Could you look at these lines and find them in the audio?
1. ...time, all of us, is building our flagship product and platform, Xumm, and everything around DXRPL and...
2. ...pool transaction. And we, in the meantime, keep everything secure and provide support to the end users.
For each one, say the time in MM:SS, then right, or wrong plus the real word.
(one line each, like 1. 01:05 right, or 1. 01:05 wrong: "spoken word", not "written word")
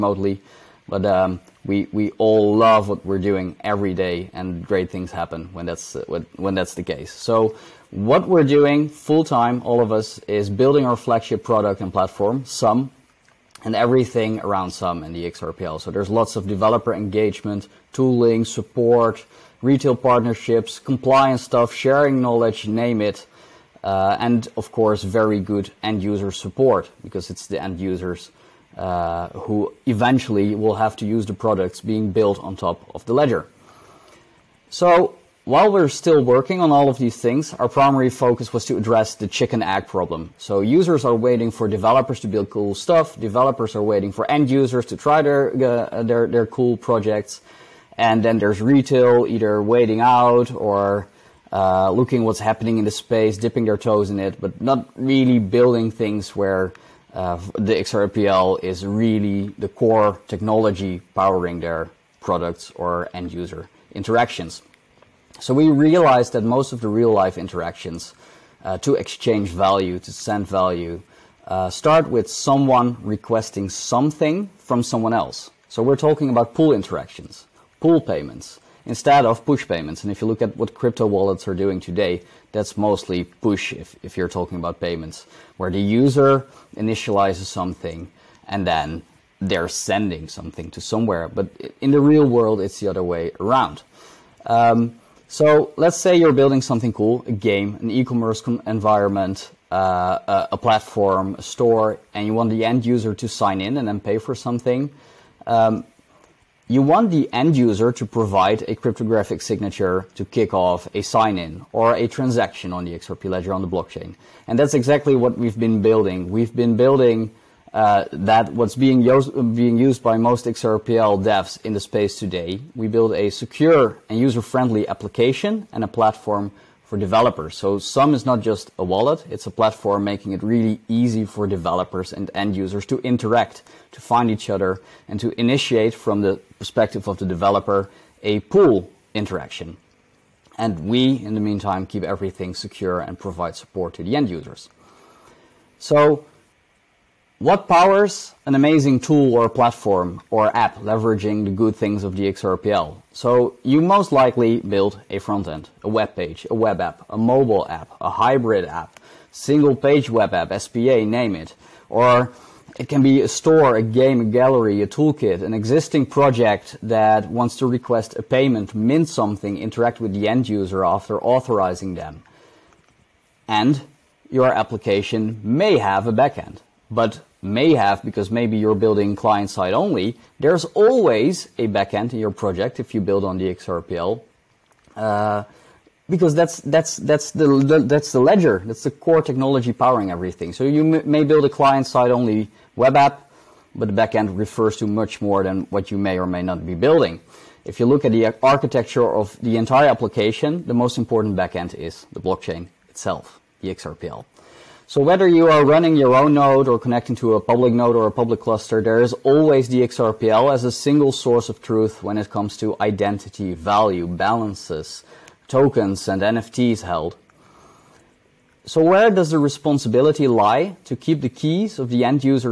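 1. 00:09 wrong: "Xumm", not "DXRPL"
2. 02:18 wrong: "interaction", not "transaction".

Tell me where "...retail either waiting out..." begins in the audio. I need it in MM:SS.
00:48.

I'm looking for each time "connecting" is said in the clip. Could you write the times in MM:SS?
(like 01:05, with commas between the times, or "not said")
03:26.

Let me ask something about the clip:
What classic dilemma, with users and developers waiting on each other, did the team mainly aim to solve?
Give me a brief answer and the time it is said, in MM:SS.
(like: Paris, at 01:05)
chicken egg problem, at 00:39.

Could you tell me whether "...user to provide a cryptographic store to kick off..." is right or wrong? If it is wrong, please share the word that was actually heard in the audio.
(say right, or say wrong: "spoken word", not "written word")
wrong: "signature", not "store".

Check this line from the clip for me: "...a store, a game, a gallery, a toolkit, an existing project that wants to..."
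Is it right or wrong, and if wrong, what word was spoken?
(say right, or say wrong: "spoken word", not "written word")
right.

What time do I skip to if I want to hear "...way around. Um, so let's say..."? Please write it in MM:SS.
01:33.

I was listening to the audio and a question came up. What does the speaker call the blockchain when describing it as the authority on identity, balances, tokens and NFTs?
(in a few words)
single source of truth.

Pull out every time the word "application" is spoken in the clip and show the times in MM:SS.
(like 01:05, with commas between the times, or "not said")
02:04, 02:54, 03:19.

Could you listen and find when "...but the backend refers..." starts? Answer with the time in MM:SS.
03:13.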